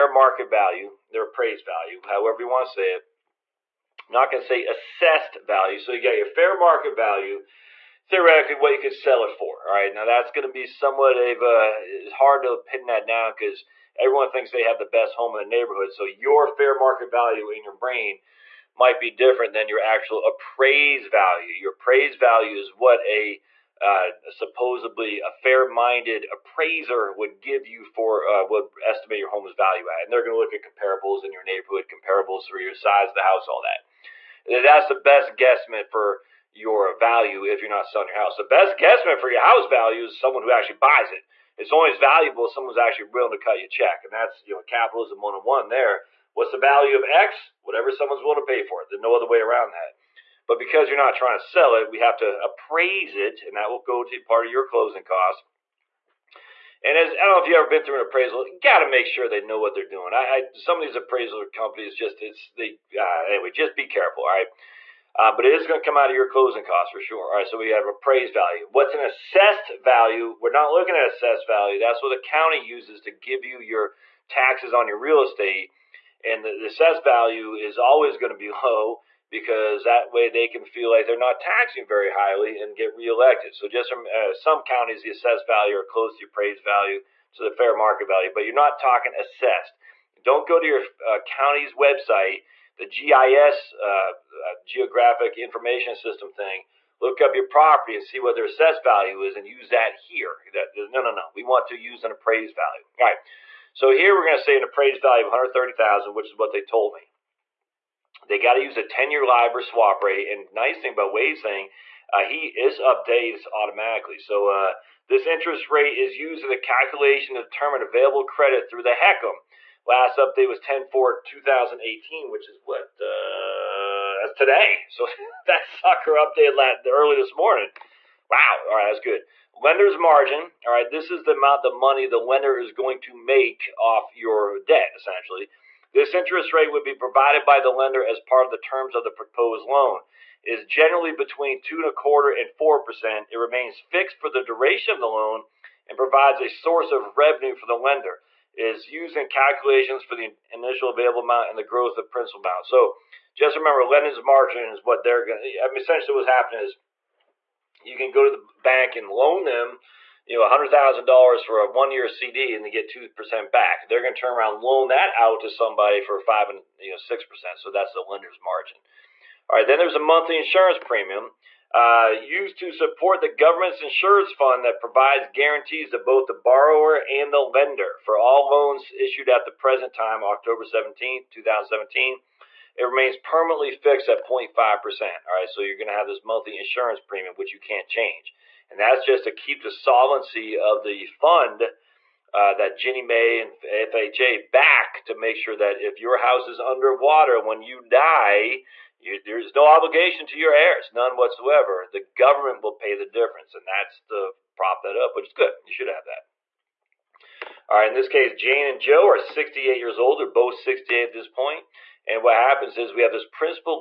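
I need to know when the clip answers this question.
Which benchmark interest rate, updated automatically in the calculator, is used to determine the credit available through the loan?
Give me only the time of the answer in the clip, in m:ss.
1:48.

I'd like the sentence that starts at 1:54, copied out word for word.
So uh, this interest rate is used in the calculation to determine available credit through the HECM.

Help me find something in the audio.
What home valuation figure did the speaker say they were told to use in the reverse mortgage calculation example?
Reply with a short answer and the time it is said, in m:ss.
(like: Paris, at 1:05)
130,000, at 1:45.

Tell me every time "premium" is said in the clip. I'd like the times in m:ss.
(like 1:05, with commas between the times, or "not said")
2:50, 3:07.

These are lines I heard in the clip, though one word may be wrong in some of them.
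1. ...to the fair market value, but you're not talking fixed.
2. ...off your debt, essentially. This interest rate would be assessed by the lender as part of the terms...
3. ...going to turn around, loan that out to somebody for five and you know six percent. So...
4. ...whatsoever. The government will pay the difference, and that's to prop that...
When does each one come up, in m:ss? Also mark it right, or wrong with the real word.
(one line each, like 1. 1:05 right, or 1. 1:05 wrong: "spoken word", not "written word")
1. 1:27 wrong: "assessed", not "fixed"
2. 2:13 wrong: "provided", not "assessed"
3. 2:44 right
4. 3:21 right.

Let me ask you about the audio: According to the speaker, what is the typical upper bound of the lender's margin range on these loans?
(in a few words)
4 percent.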